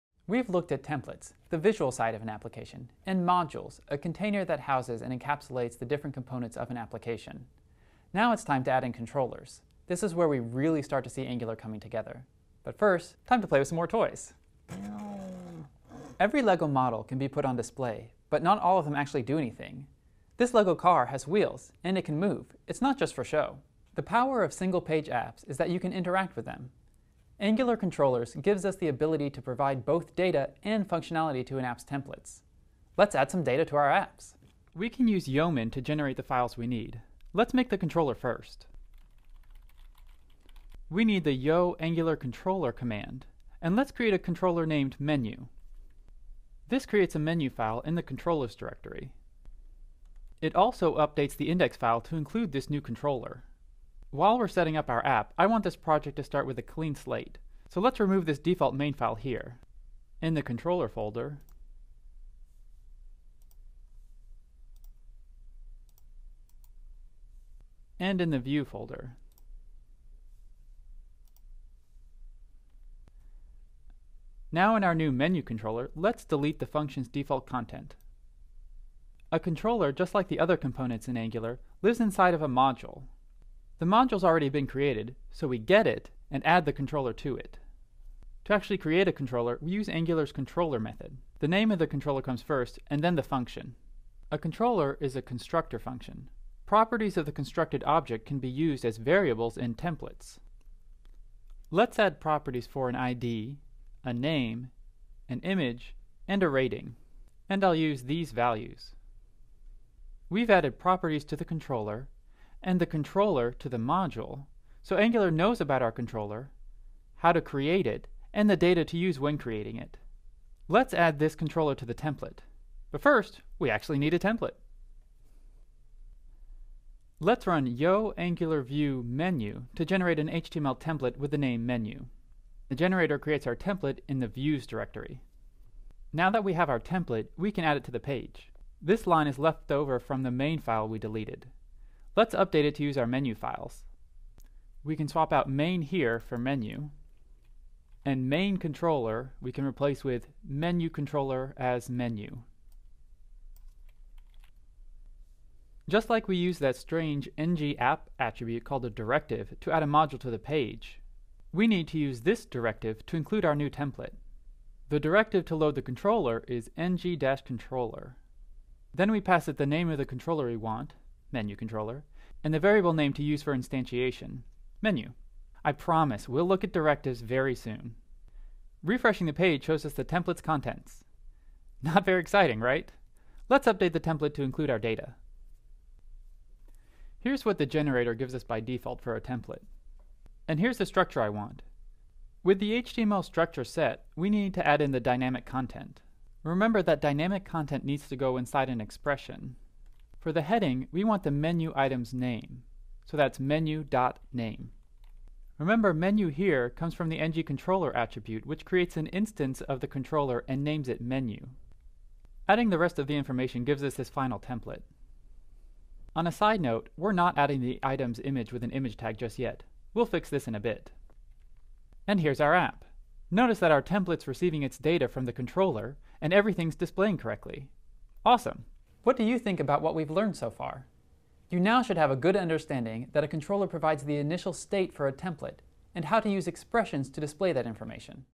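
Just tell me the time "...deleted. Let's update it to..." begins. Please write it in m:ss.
2:20.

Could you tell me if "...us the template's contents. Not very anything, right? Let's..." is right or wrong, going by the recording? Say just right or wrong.
wrong.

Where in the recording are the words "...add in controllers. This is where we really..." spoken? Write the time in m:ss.
0:08.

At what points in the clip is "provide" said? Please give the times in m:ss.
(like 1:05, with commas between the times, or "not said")
0:29, 3:53.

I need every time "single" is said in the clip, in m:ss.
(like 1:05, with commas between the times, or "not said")
0:24.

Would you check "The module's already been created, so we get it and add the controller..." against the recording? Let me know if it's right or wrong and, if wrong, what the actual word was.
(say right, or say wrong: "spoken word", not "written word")
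right.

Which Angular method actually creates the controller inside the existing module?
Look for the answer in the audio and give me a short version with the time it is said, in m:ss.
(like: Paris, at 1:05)
controller method, at 1:30.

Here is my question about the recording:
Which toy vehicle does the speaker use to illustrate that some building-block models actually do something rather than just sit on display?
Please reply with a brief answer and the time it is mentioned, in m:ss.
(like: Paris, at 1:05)
LEGO car, at 0:20.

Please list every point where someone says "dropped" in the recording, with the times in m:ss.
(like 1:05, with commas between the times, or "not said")
not said.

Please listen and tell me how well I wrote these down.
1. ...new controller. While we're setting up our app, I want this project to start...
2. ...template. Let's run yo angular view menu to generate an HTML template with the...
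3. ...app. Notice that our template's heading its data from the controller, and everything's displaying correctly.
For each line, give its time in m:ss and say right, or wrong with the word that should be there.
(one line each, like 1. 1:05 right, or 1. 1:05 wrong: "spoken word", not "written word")
1. 0:52 right
2. 2:04 right
3. 3:42 wrong: "receiving", not "heading".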